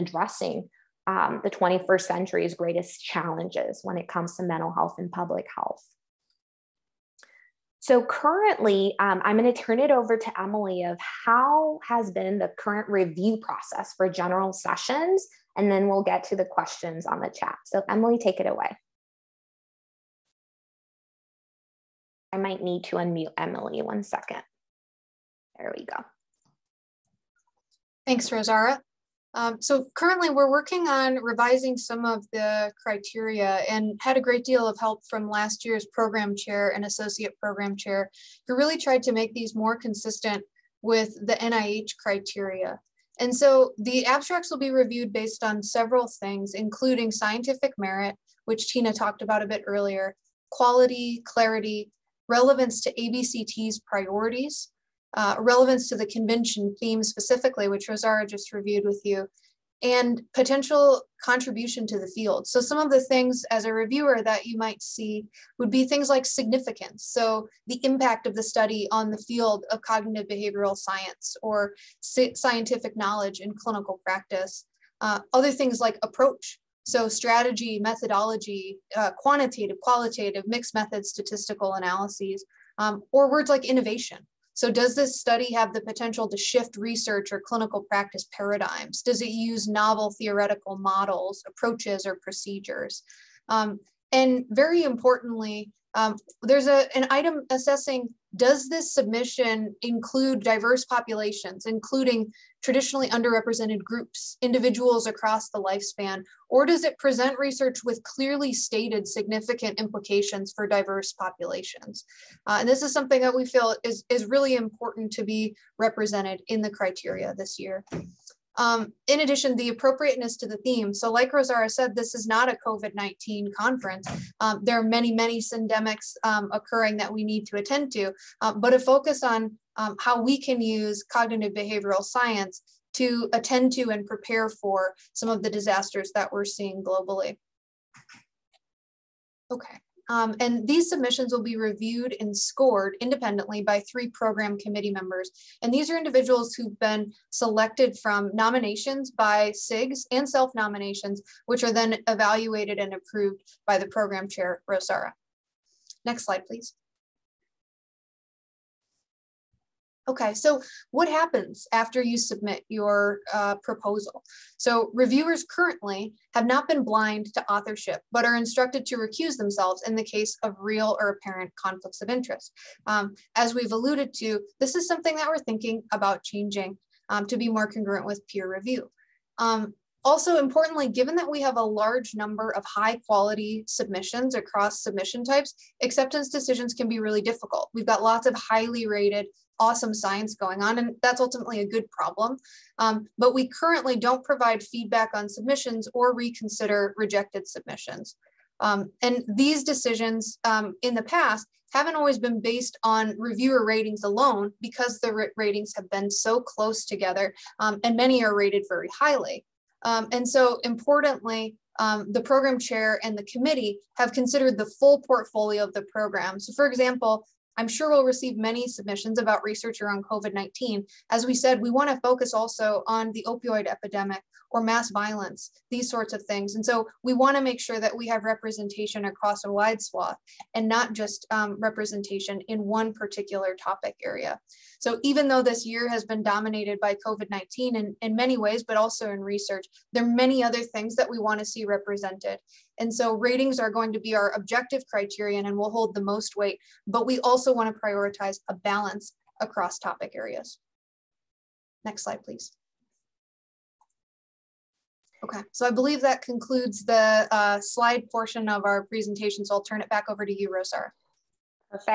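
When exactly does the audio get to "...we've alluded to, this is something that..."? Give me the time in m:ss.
2:53.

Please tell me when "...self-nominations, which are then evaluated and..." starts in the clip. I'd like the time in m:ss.
2:30.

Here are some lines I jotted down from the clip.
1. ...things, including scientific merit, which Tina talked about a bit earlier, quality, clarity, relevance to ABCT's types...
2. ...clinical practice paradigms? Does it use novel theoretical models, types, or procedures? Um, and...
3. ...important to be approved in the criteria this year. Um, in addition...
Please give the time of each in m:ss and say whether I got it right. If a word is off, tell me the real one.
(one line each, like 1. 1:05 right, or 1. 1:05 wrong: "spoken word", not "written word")
1. 0:46 wrong: "priorities", not "types"
2. 1:27 wrong: "approaches", not "types"
3. 1:54 wrong: "represented", not "approved".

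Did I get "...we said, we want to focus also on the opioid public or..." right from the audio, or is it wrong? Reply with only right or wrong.
wrong.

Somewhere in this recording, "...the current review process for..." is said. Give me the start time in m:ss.
0:12.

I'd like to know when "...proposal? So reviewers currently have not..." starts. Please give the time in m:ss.
2:43.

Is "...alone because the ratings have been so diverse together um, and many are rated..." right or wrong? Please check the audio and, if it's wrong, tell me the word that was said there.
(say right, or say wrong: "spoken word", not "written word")
wrong: "close", not "diverse".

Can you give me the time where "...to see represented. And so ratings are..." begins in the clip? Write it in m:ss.
4:01.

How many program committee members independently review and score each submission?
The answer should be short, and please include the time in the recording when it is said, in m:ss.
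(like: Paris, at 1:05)
3, at 2:23.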